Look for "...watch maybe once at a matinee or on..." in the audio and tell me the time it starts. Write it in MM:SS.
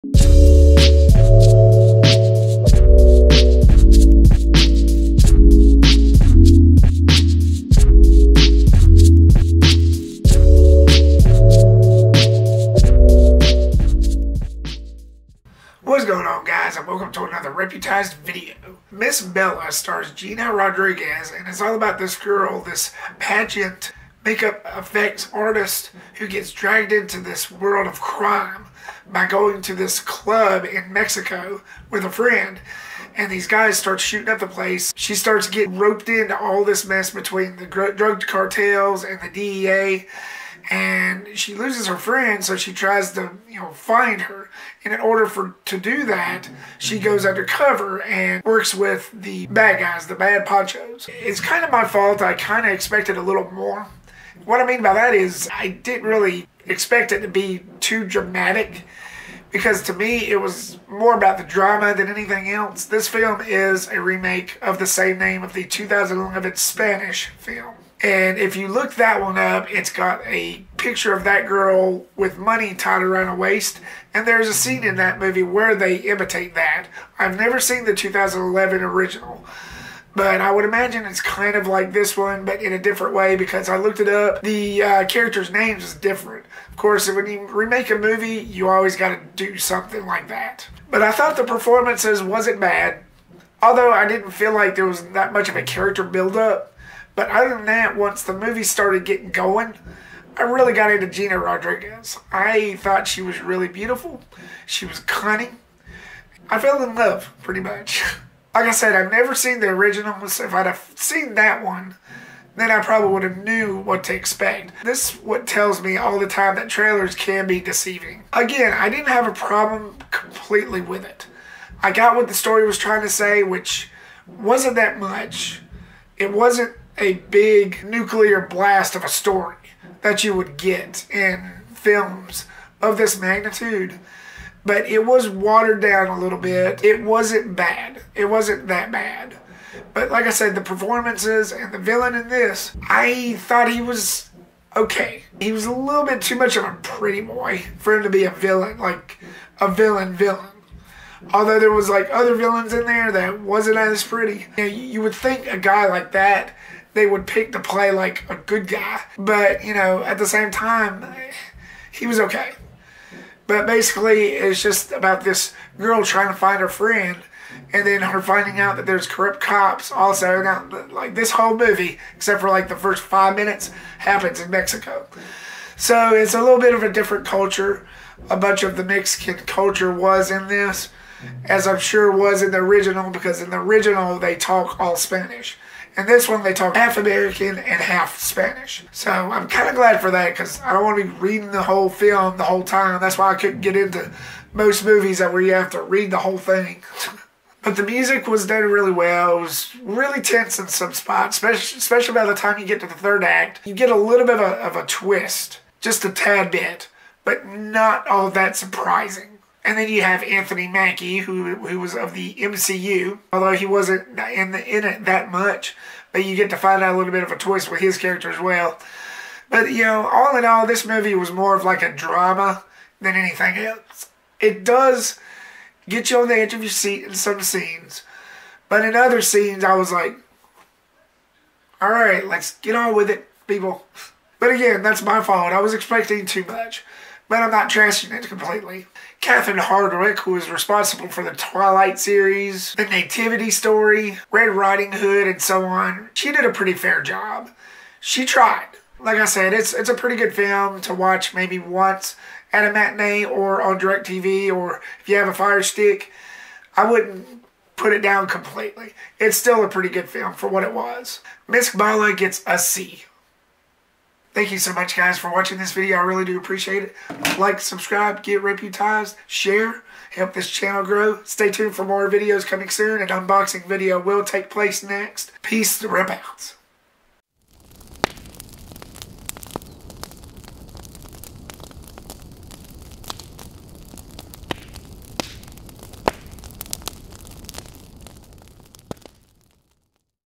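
04:10.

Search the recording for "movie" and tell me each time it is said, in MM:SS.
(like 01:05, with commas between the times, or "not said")
01:15, 01:27, 01:38, 02:51, 03:14, 03:40.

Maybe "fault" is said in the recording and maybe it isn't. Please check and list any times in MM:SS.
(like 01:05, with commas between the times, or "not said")
00:51, 03:55.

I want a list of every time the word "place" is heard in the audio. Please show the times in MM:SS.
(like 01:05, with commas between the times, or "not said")
00:34, 04:34.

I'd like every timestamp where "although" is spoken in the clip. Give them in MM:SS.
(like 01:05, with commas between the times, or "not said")
01:33, 02:31, 03:33.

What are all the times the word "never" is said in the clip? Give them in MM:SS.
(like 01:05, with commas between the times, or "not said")
01:17, 01:49.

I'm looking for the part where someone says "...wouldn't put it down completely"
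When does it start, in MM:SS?
04:16.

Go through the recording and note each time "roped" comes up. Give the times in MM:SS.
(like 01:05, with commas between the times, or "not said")
00:35.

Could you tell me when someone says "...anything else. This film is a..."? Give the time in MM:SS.
01:02.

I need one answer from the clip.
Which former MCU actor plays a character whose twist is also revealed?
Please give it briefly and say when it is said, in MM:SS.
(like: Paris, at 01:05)
Anthony Mackie, at 03:30.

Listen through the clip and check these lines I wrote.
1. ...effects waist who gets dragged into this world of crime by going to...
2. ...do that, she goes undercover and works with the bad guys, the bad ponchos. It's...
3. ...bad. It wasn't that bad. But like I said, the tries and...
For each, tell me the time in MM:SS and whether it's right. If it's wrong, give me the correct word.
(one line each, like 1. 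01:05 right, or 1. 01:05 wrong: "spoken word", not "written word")
1. 00:24 wrong: "artist", not "waist"
2. 00:45 right
3. 02:17 wrong: "performances", not "tries".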